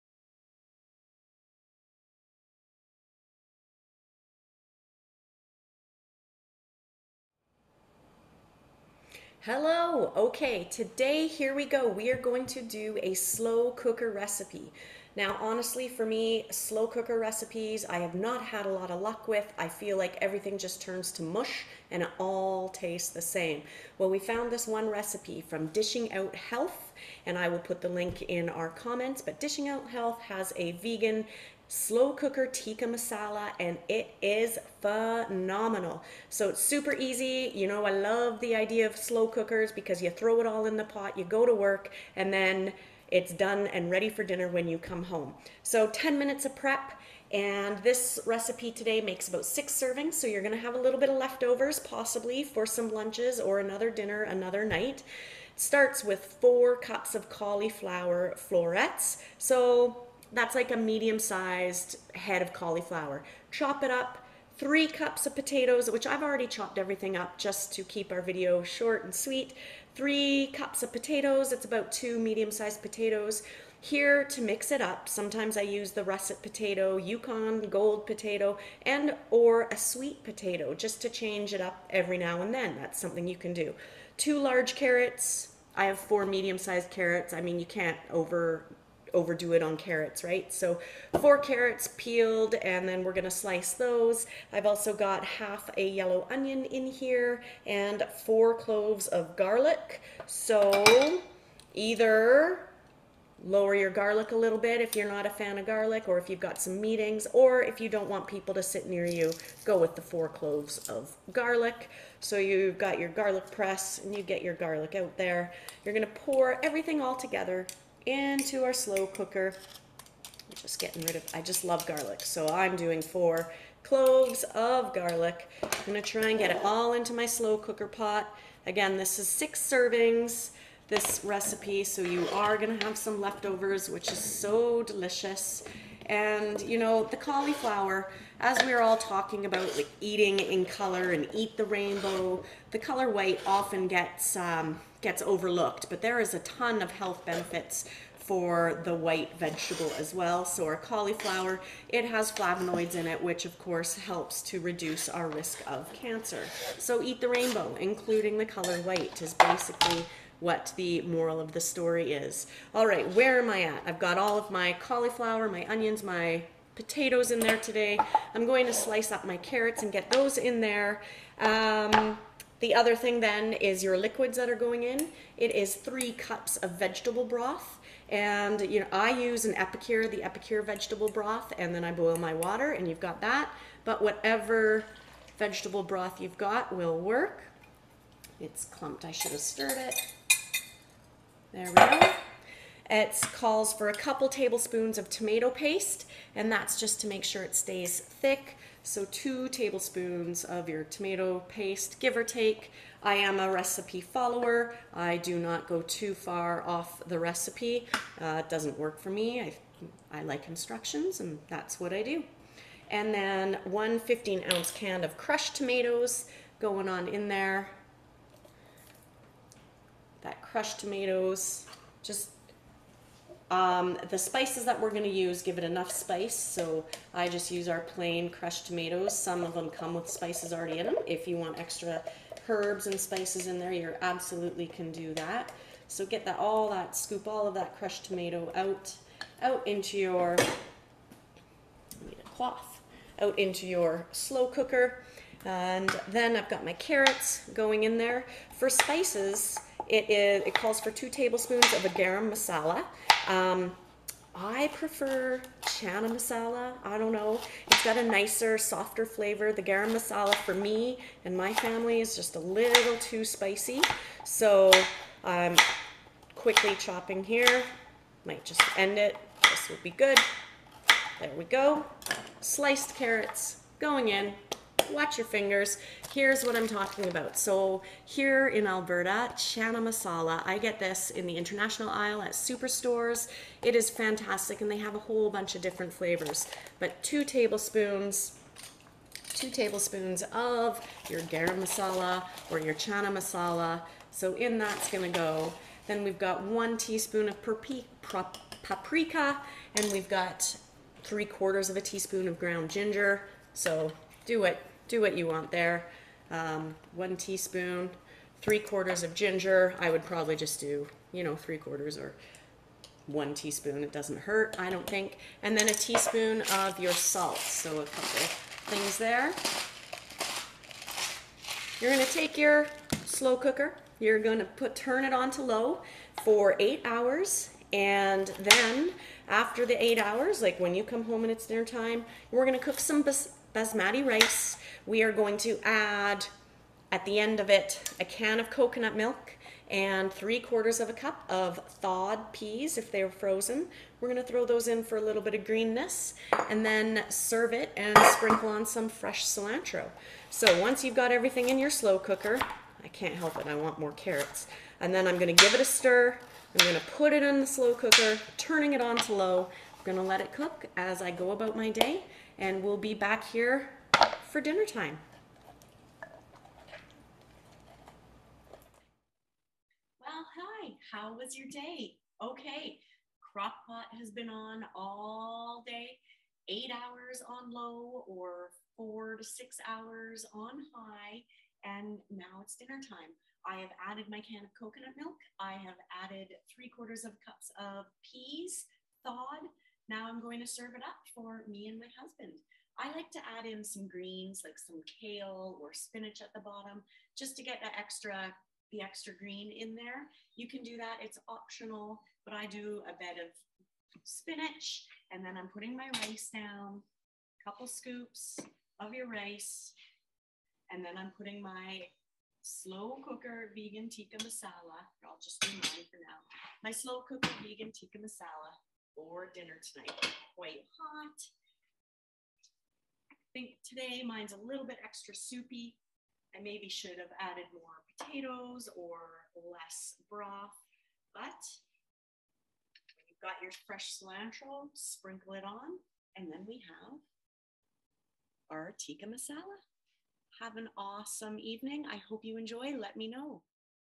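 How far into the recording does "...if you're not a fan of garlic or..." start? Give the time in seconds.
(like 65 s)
104 s.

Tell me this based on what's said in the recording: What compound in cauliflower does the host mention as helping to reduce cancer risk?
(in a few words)
flavonoids.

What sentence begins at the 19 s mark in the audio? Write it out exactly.
I feel like everything just turns to mush and it all tastes the same.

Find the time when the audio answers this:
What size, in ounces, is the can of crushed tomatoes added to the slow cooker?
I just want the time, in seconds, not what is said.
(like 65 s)
213 s.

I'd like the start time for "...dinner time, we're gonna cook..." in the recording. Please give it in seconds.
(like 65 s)
331 s.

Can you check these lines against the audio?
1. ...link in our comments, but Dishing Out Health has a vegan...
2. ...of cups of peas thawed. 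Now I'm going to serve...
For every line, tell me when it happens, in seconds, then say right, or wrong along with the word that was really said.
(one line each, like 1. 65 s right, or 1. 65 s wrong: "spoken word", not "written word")
1. 27 s right
2. 387 s right.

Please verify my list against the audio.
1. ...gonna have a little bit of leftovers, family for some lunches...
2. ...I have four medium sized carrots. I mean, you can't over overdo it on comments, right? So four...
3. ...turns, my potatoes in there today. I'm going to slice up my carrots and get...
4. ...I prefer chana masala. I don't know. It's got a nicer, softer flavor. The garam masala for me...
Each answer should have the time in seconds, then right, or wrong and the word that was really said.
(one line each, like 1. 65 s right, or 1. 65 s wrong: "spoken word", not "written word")
1. 50 s wrong: "possibly", not "family"
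2. 85 s wrong: "carrots", not "comments"
3. 165 s wrong: "onions", not "turns"
4. 254 s right.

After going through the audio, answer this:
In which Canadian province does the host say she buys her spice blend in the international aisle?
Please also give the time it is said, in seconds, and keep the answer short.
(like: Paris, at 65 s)
Alberta, at 278 s.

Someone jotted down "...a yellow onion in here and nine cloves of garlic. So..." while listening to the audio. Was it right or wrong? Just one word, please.
wrong.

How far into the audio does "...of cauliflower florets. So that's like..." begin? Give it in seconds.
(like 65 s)
57 s.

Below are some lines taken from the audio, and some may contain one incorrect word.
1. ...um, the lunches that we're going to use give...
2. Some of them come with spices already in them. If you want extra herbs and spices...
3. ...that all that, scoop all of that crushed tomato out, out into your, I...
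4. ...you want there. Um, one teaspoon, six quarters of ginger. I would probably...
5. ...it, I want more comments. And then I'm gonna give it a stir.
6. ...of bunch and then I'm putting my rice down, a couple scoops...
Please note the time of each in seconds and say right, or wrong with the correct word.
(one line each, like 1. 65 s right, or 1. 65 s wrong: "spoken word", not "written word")
1. 223 s wrong: "spices", not "lunches"
2. 229 s right
3. 236 s right
4. 305 s wrong: "three", not "six"
5. 353 s wrong: "carrots", not "comments"
6. 403 s wrong: "spinach", not "bunch".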